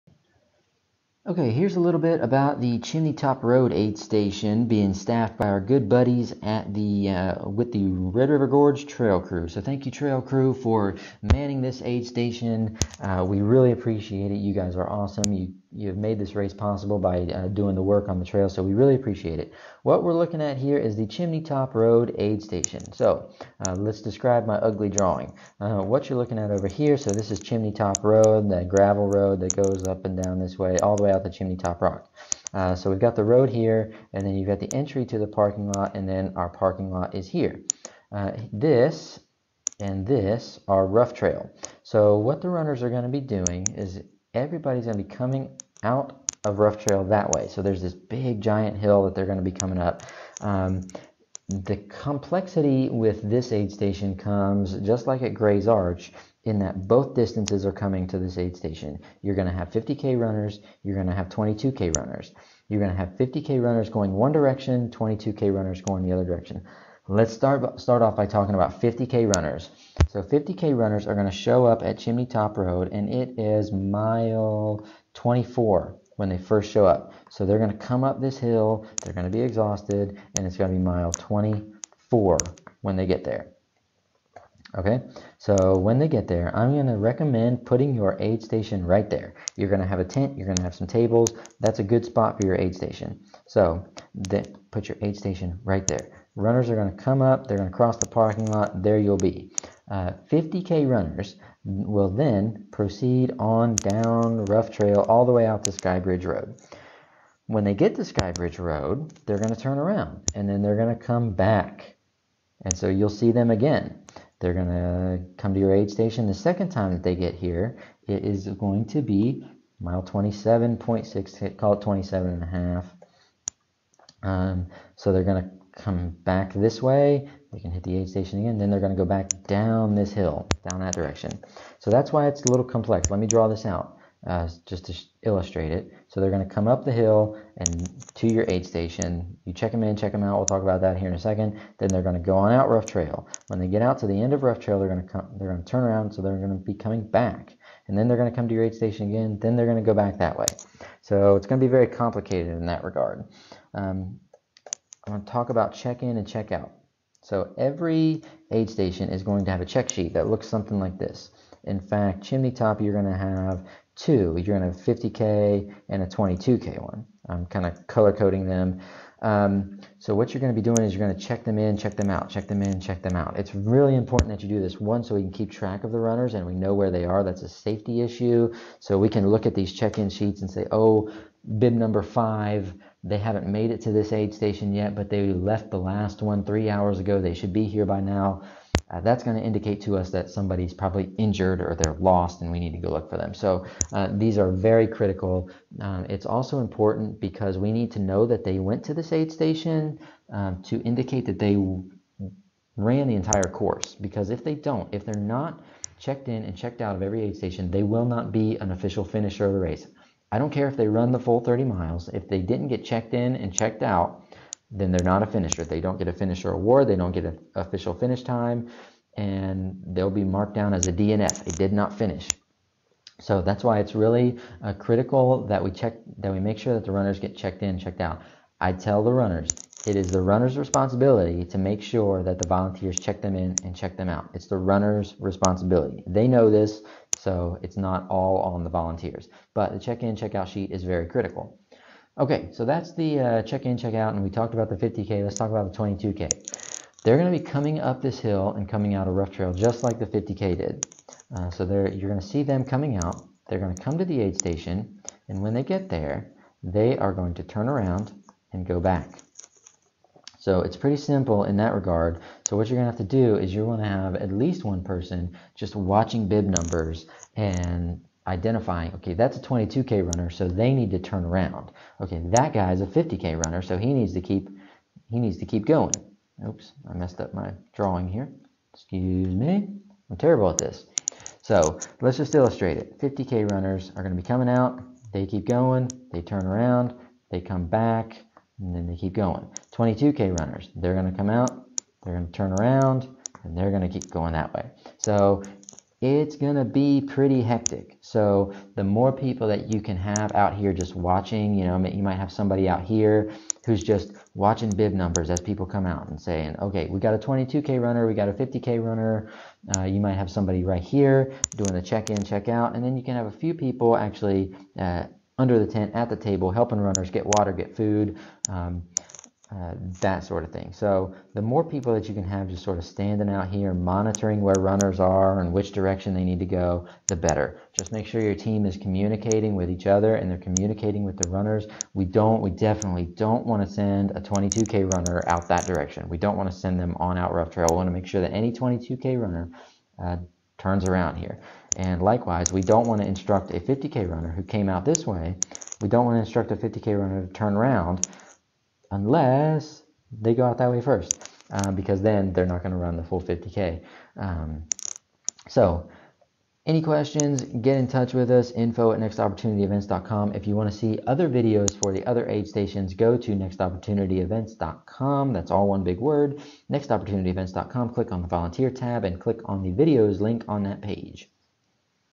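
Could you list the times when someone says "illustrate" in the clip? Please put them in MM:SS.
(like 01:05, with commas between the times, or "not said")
02:15, 04:42.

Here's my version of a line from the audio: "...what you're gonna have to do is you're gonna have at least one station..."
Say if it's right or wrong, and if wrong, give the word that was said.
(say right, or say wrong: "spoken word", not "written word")
wrong: "person", not "station".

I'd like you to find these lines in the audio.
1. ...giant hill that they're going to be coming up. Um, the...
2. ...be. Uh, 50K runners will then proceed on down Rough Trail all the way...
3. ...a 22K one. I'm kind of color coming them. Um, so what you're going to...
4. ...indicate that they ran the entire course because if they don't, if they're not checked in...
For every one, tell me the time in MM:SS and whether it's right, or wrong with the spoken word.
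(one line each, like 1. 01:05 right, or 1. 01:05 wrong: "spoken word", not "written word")
1. 00:48 right
2. 01:39 right
3. 02:46 wrong: "coding", not "coming"
4. 03:20 right.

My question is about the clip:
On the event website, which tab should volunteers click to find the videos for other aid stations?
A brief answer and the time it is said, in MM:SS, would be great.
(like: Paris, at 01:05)
volunteer tab, at 06:08.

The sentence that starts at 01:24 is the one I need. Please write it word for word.
Okay, so when they get there, I'm going to recommend putting your aid station right there.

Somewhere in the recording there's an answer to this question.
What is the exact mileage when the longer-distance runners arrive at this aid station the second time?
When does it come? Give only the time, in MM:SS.
02:00.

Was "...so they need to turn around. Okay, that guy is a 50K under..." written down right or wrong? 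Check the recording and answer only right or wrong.
wrong.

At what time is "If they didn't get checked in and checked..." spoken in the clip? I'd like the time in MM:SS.
03:32.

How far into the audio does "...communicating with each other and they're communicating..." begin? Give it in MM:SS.
05:28.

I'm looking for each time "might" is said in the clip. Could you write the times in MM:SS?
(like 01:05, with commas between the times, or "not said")
05:02, 05:10.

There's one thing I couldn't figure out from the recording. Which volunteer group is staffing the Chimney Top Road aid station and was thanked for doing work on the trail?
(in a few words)
Red River Gorge Trail Crew.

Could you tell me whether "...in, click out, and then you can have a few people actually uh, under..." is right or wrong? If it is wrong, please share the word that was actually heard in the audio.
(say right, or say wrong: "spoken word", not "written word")
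wrong: "check", not "click".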